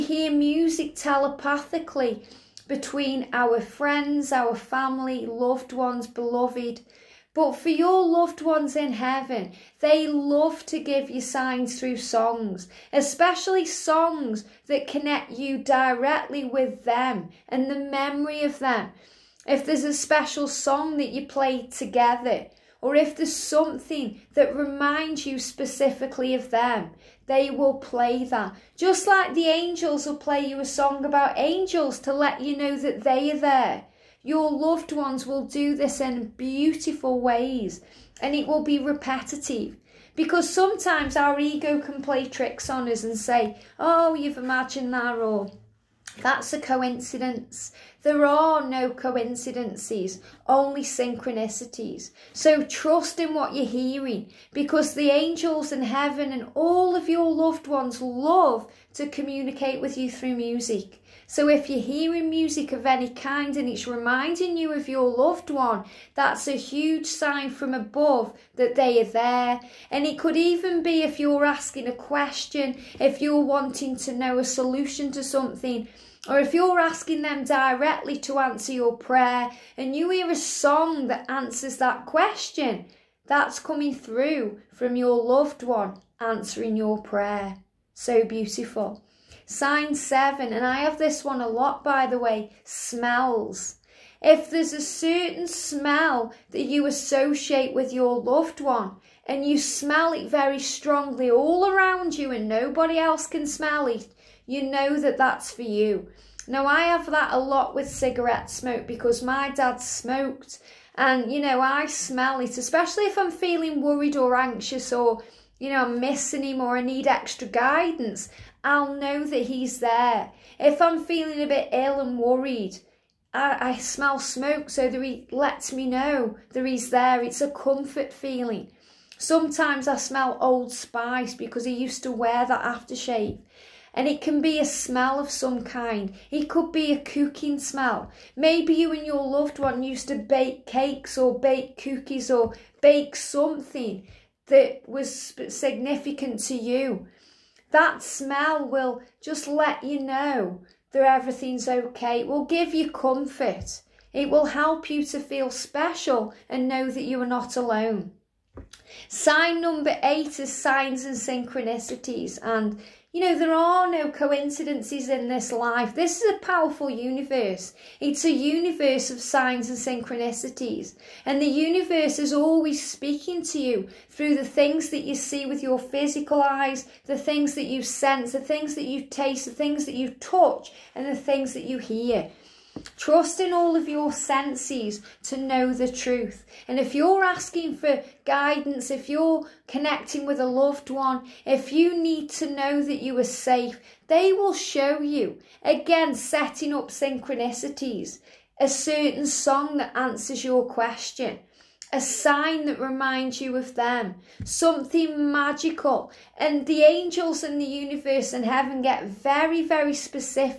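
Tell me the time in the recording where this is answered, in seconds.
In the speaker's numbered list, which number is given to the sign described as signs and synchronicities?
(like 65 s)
160 s.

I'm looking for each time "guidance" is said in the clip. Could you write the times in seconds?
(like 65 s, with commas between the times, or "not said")
117 s, 188 s.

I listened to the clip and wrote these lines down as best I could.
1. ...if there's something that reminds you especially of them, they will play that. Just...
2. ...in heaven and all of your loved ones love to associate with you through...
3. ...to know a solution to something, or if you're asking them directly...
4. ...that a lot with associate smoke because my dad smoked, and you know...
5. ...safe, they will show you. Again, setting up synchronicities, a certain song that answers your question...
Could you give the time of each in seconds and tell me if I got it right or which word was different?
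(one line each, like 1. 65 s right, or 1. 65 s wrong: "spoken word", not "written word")
1. 22 s wrong: "specifically", not "especially"
2. 55 s wrong: "communicate", not "associate"
3. 73 s right
4. 107 s wrong: "cigarette", not "associate"
5. 193 s right.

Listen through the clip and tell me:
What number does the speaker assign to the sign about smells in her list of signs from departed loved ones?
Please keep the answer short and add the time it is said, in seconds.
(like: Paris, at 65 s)
7, at 89 s.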